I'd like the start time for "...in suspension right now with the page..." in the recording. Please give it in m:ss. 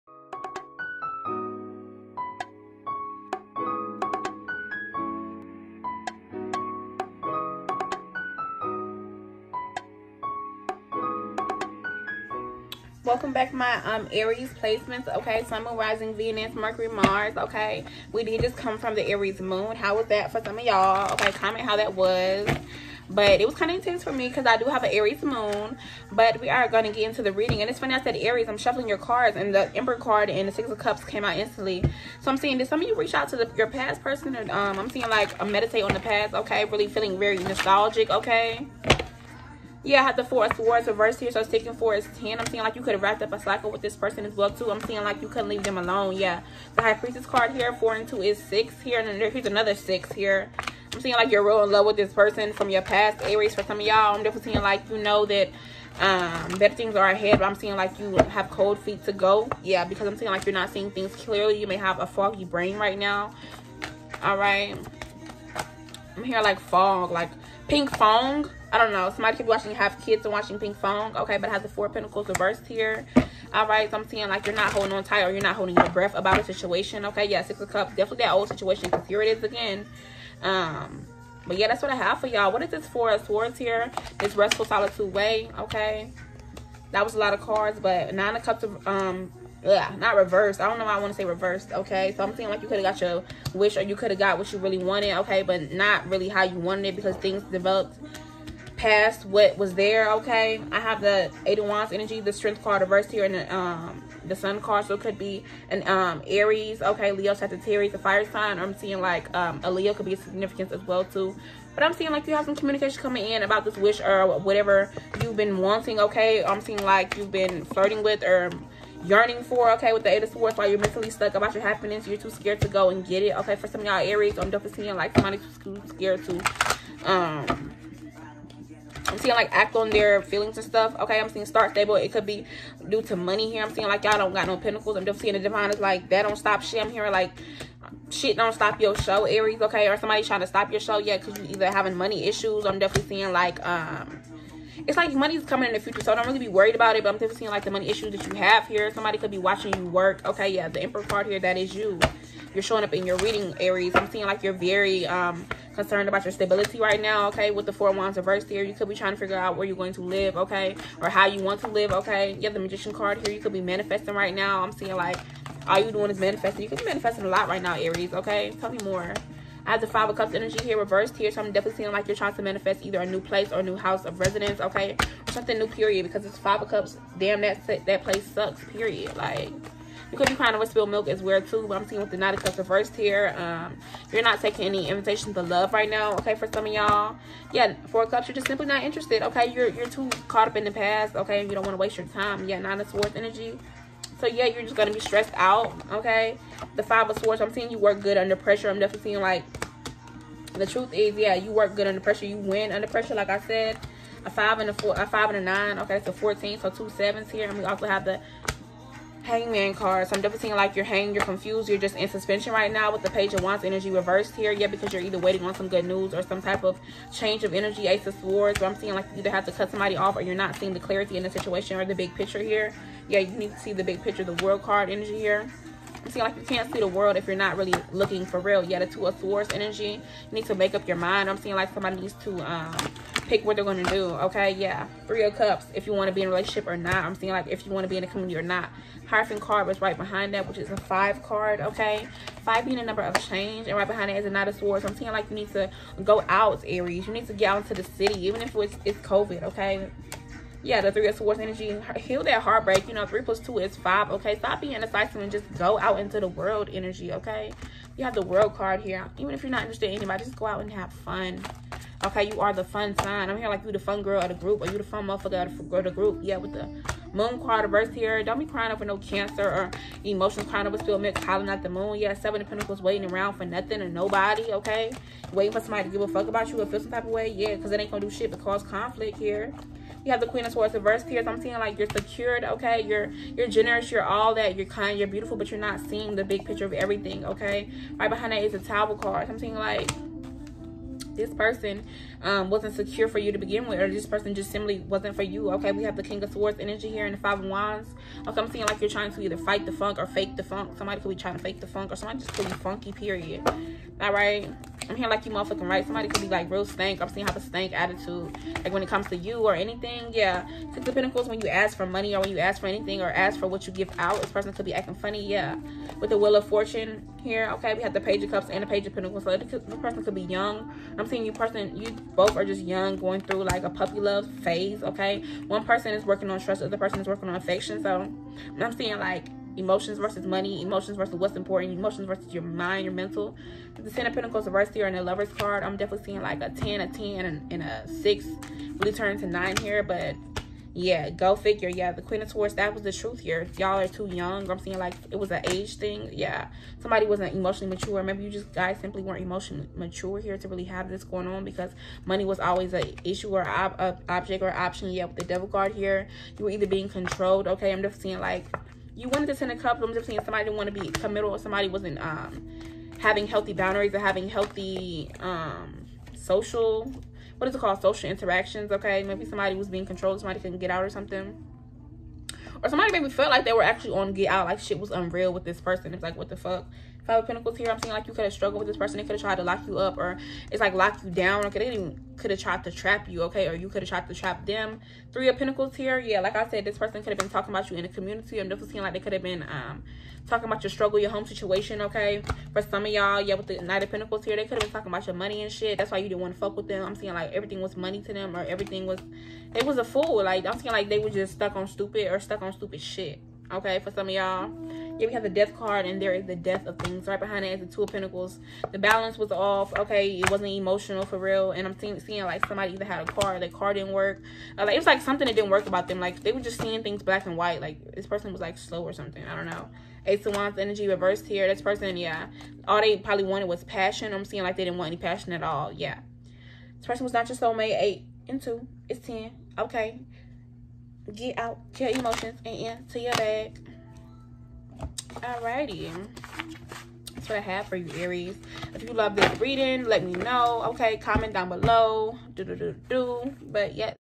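3:31.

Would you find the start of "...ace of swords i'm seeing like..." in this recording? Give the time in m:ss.
3:37.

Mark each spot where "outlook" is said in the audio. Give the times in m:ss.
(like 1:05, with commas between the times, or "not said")
not said.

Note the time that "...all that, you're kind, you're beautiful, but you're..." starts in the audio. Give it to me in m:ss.
4:44.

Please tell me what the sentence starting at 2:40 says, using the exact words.
Or how you want to live, okay?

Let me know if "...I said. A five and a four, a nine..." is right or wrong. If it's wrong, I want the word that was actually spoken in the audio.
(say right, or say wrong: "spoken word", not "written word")
wrong: "five", not "nine".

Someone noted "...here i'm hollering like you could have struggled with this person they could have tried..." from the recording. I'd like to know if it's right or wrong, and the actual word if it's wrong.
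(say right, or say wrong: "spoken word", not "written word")
wrong: "saying", not "hollering".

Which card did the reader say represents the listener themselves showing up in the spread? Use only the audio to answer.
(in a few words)
The Emperor.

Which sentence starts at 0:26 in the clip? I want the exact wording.
But we are going to get into the reading.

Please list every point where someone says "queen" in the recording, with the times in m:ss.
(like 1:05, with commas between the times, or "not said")
4:40, 5:42.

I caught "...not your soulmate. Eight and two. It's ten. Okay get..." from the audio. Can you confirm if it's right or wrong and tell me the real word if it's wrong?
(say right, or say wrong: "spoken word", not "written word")
right.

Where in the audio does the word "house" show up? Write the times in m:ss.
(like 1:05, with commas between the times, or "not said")
2:53.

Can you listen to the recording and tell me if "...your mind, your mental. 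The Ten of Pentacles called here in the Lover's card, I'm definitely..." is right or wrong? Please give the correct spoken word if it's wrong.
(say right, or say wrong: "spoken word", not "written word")
wrong: "reversed", not "called".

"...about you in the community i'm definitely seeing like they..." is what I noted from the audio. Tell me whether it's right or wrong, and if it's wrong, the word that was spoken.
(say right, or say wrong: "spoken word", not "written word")
right.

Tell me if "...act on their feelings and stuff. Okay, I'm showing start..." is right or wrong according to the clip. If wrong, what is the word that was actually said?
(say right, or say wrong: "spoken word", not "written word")
wrong: "seeing", not "showing".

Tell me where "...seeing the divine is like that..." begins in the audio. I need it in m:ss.
2:15.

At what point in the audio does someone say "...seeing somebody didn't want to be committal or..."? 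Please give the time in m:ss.
6:00.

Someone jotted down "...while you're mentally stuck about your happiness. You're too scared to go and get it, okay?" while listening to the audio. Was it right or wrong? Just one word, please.
right.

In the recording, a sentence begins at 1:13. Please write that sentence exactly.
All right, so I'm seeing like you're not holding on tight or you're not holding your breath about a situation.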